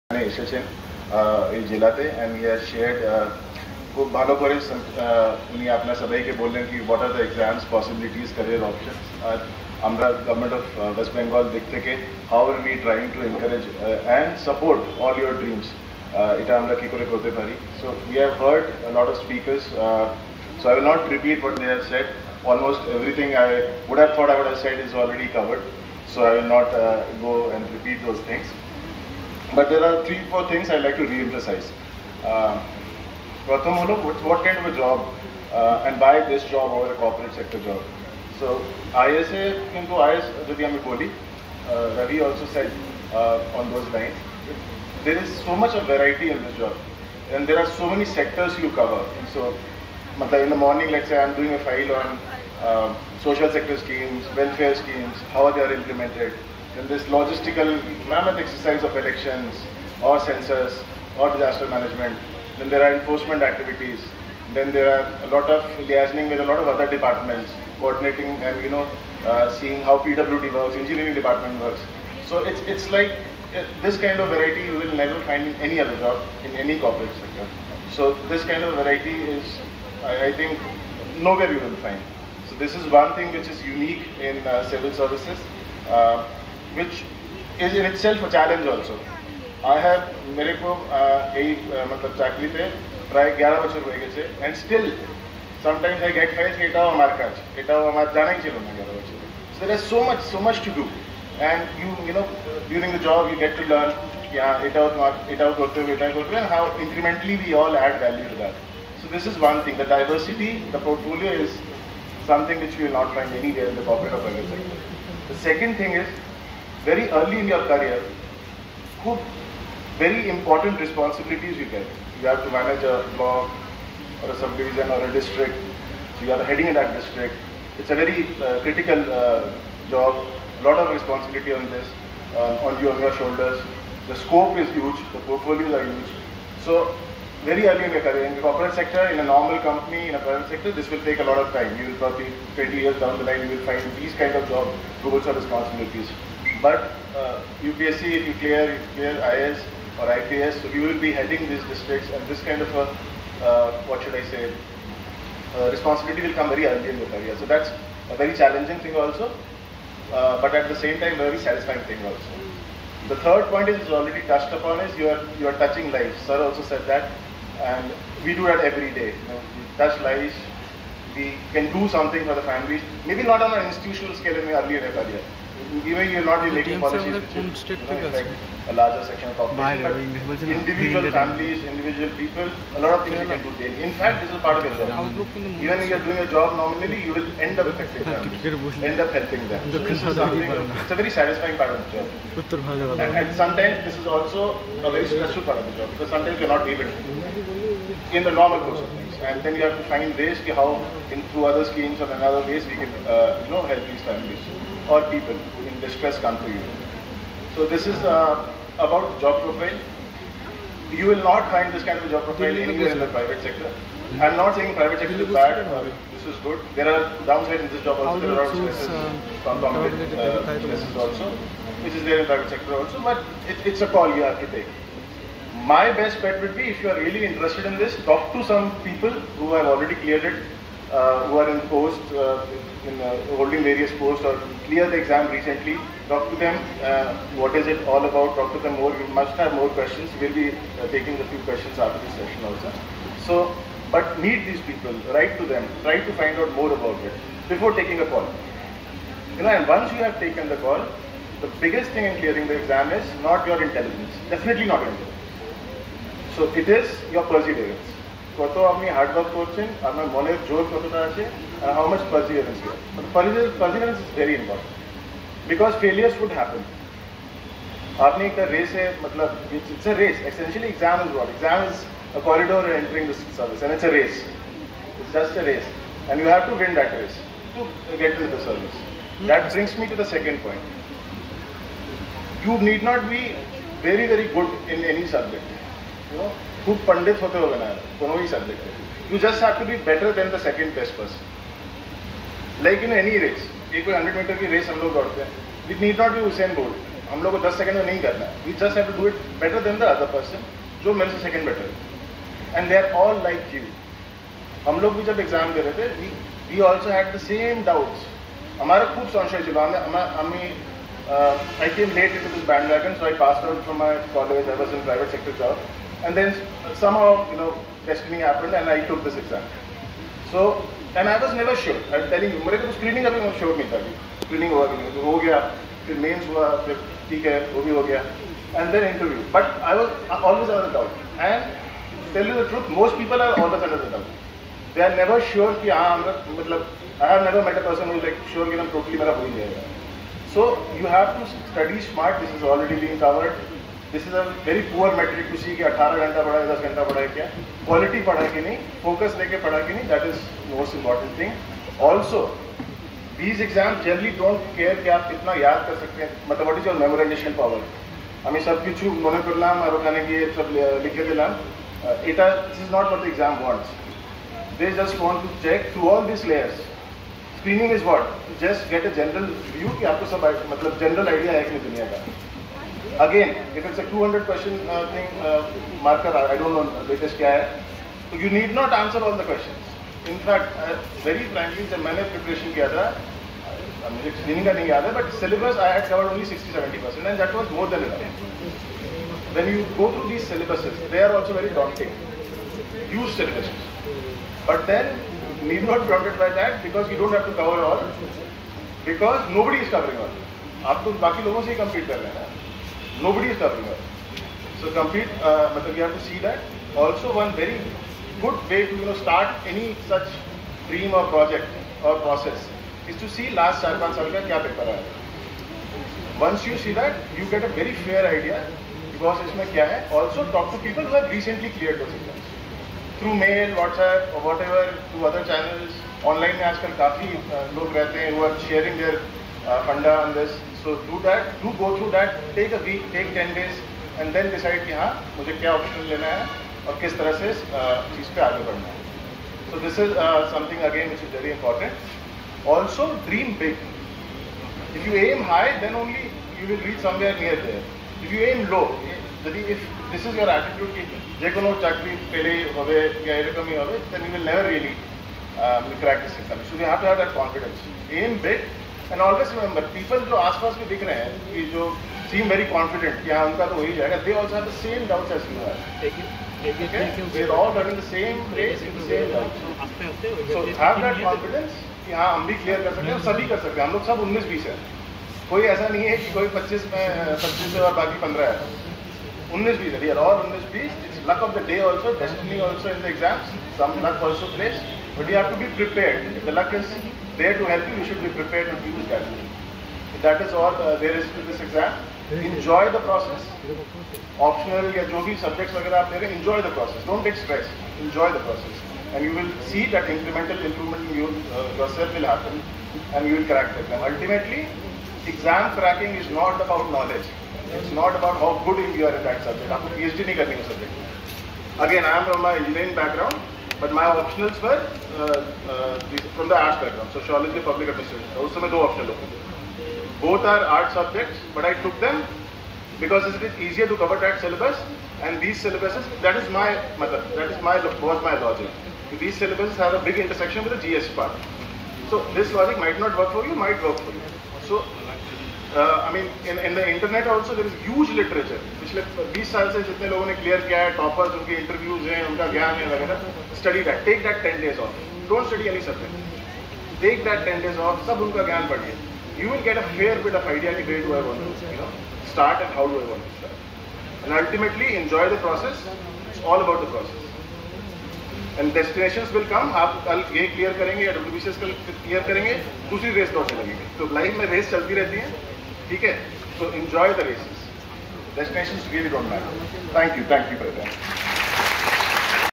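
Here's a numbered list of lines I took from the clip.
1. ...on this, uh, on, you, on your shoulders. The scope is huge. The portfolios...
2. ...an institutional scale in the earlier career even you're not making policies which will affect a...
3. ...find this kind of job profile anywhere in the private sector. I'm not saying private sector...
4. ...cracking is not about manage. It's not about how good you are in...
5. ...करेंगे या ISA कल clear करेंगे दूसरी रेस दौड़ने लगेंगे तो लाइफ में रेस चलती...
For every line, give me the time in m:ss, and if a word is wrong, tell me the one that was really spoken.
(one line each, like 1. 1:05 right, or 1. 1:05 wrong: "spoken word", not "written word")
1. 2:11 right
2. 2:53 right
3. 3:31 right
4. 8:25 wrong: "knowledge", not "manage"
5. 9:20 wrong: "WBCS", not "ISA".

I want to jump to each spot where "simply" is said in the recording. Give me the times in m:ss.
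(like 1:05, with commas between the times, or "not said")
not said.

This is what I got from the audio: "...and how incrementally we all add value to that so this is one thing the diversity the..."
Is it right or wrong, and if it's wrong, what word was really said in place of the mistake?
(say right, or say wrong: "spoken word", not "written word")
right.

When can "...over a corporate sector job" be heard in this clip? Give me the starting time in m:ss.
0:36.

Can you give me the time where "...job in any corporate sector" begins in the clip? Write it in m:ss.
1:15.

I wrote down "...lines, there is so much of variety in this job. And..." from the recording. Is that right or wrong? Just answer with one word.
right.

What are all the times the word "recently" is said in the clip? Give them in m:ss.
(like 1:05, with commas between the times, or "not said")
3:55, 7:01.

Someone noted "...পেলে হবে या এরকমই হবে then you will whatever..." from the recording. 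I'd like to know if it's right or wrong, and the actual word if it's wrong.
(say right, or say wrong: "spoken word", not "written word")
wrong: "never", not "whatever".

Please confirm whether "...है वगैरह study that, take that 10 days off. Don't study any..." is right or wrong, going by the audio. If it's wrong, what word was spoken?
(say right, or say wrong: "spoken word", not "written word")
right.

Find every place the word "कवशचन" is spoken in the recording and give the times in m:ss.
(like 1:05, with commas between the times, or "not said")
6:14, 6:19.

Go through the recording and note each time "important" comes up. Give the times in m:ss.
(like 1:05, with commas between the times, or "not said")
2:00, 7:21.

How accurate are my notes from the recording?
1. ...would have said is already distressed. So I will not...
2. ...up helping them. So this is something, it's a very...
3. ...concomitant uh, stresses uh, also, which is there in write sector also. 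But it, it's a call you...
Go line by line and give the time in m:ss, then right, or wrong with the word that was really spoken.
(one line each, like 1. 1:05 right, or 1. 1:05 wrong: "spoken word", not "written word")
1. 0:24 wrong: "covered", not "distressed"
2. 3:08 right
3. 3:39 wrong: "private", not "write".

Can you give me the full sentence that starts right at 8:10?
That is all uh, there is to this exam.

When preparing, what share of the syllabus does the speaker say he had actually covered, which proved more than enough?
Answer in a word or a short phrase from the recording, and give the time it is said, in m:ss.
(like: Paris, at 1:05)
60 to 70, at 6:26.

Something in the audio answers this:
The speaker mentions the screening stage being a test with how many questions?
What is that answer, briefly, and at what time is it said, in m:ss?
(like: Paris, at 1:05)
200, at 6:13.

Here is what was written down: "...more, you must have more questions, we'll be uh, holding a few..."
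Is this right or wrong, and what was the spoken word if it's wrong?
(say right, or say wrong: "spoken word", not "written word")
wrong: "taking", not "holding".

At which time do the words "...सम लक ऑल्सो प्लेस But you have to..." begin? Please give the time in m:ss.
8:03.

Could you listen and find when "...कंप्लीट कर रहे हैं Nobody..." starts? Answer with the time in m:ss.
6:41.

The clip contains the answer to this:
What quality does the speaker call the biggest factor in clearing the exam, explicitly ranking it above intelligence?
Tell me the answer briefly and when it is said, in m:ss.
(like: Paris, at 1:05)
Perseverance, at 4:17.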